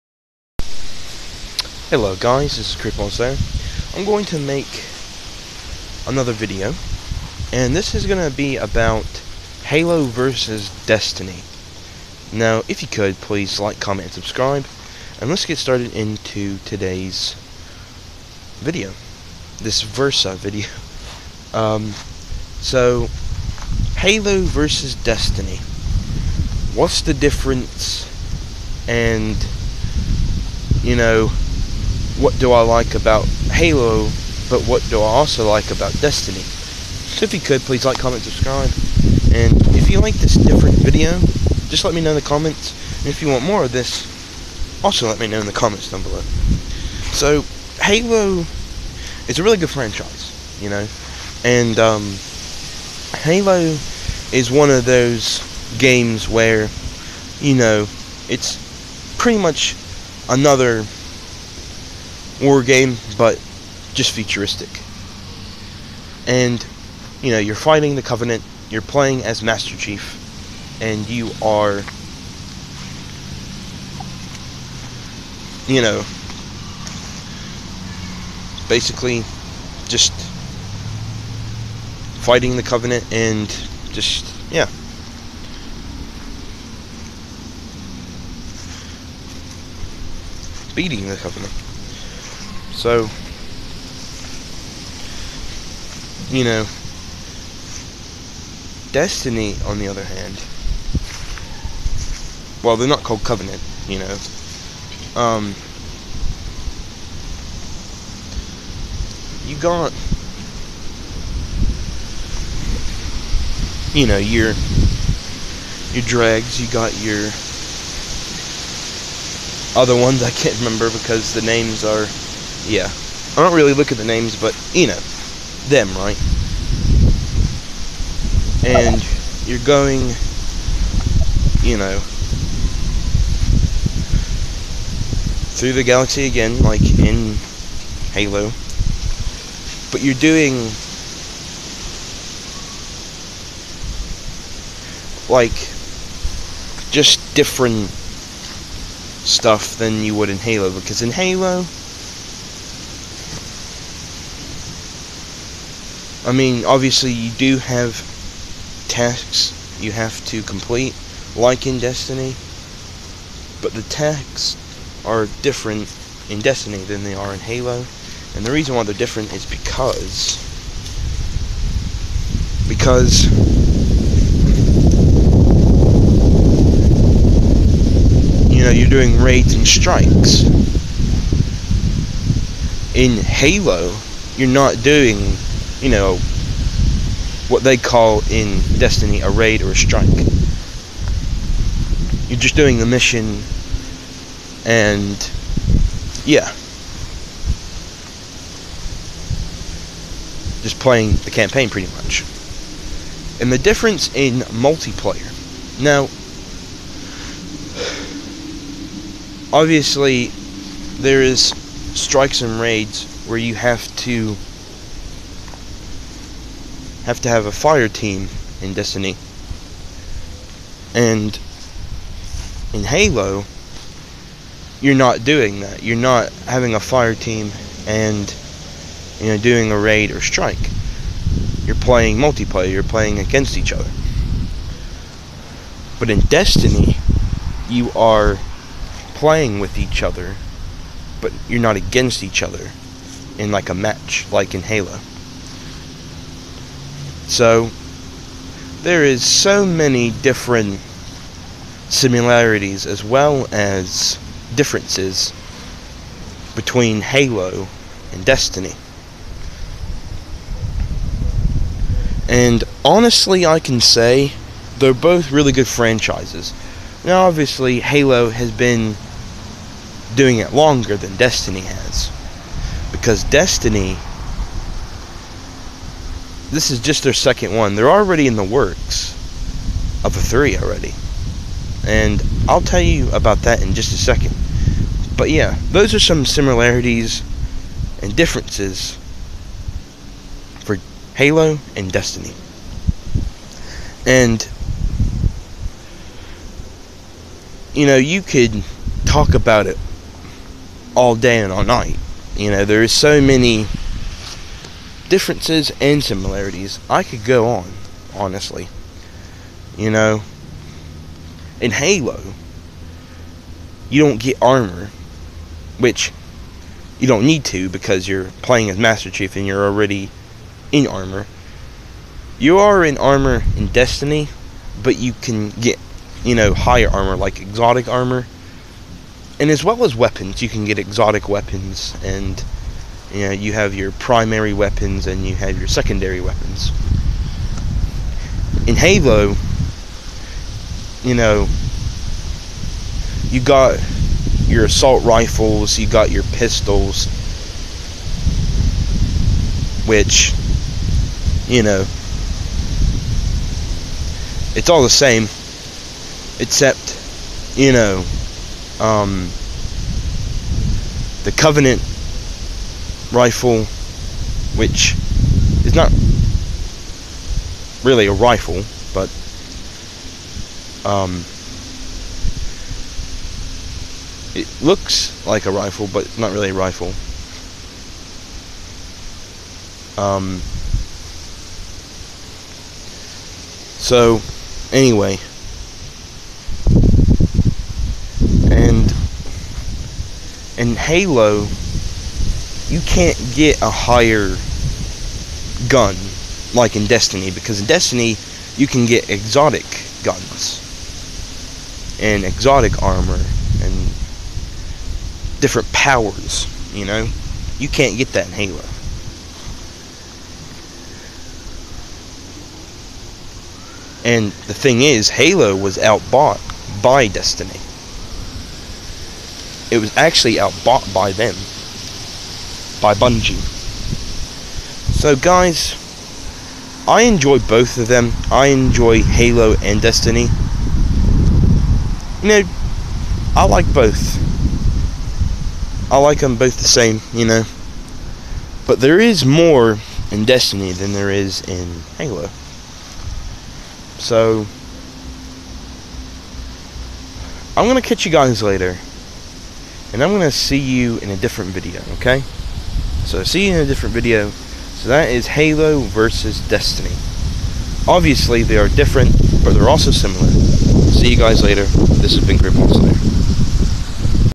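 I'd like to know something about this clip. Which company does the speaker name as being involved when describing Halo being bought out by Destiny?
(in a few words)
Bungie.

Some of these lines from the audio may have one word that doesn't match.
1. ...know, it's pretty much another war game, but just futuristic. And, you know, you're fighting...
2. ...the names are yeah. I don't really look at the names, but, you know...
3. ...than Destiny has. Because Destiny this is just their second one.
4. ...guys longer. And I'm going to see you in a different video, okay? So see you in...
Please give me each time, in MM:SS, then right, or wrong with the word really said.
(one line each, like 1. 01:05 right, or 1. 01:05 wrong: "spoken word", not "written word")
1. 00:57 right
2. 02:01 right
3. 04:30 right
4. 07:28 wrong: "later", not "longer".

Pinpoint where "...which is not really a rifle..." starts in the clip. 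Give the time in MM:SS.
06:04.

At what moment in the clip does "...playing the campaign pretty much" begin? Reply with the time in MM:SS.
03:20.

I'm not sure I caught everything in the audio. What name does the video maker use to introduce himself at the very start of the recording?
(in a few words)
Creeper.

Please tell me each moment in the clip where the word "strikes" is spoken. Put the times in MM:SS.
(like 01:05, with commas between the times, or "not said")
02:59, 03:09, 03:31, 03:50.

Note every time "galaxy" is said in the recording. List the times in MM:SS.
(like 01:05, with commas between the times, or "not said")
02:15.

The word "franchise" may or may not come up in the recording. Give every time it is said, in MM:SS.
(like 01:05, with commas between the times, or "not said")
00:49, 04:25.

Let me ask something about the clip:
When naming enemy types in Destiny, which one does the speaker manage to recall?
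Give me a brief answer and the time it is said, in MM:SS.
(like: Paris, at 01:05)
dregs, at 01:56.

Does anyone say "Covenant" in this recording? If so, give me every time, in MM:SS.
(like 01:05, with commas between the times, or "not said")
01:08, 01:22, 01:31, 01:43, 06:01.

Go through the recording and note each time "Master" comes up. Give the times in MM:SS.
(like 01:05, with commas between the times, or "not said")
01:09, 05:18.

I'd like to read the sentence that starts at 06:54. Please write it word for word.
And the thing is, Halo was outbought by Destiny.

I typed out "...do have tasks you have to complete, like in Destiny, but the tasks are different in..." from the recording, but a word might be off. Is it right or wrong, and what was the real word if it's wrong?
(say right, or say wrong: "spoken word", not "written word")
right.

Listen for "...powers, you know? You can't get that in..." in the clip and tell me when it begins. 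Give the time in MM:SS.
06:45.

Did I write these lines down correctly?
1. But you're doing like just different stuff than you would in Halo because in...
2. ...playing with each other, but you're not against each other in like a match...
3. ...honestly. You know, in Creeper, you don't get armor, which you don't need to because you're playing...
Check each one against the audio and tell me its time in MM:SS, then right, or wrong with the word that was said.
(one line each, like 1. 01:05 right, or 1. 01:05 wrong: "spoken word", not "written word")
1. 02:19 right
2. 03:59 right
3. 05:08 wrong: "Halo", not "Creeper".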